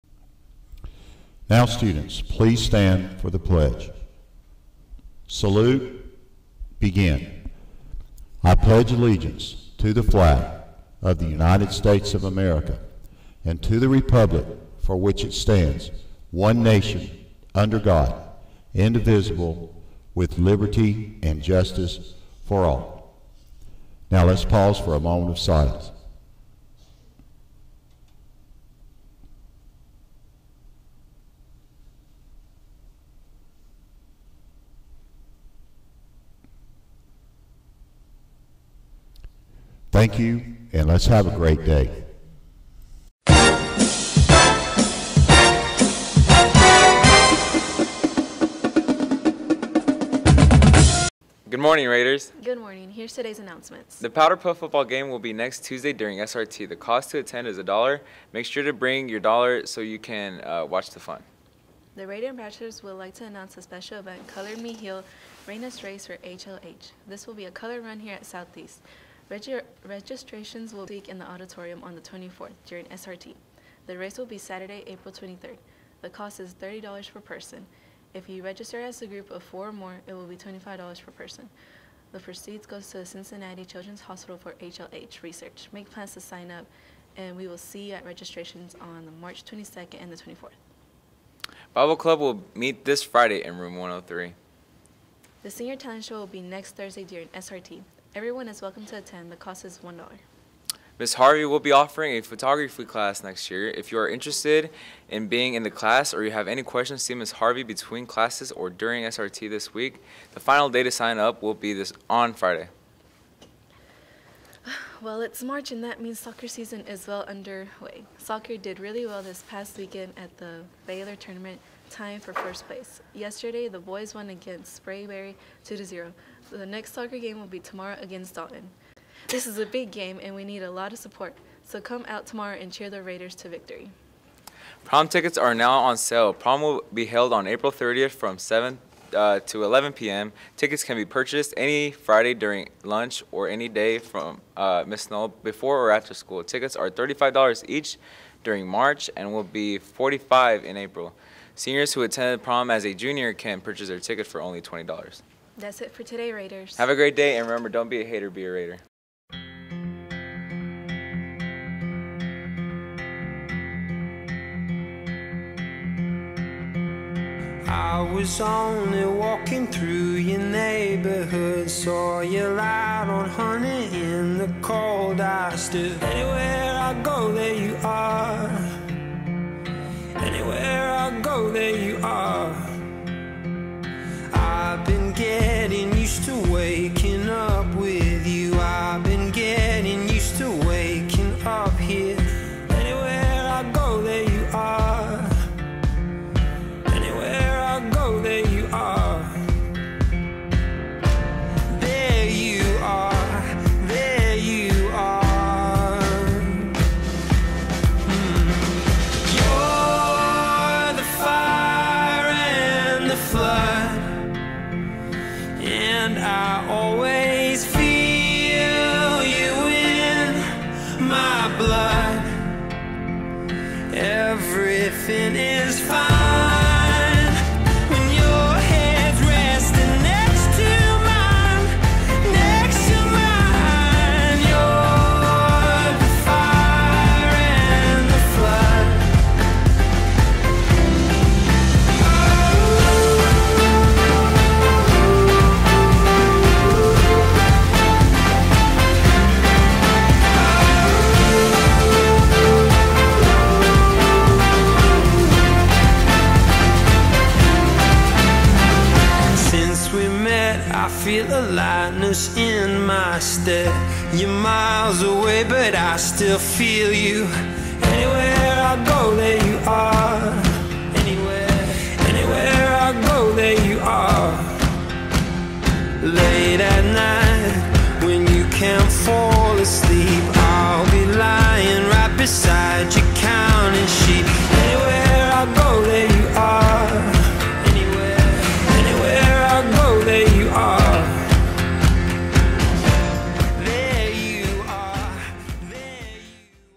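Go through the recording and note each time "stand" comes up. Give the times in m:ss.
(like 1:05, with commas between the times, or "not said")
0:02, 0:15.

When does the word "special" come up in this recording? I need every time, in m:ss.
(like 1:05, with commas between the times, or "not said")
1:03.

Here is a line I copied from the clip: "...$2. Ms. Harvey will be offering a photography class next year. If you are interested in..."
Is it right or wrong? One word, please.
wrong.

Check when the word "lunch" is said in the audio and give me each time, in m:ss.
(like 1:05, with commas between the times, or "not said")
2:22.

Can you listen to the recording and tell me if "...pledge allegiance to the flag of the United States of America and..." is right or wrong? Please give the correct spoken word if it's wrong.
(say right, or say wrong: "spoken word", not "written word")
right.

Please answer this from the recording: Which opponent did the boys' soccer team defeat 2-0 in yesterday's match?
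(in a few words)
Sprayberry.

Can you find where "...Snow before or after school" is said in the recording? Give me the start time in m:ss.
2:25.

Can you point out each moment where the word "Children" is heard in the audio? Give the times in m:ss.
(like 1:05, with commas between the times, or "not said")
1:23.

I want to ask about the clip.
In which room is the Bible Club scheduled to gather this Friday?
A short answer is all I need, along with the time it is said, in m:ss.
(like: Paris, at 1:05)
Room 103, at 1:33.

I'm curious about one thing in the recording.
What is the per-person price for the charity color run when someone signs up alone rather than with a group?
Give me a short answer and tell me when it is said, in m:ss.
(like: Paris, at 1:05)
$30, at 1:16.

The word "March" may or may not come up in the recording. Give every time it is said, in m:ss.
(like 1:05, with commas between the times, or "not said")
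1:29, 1:55, 2:28.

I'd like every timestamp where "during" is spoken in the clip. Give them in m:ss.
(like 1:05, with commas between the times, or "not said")
0:55, 1:12, 1:37, 1:48, 2:22, 2:28.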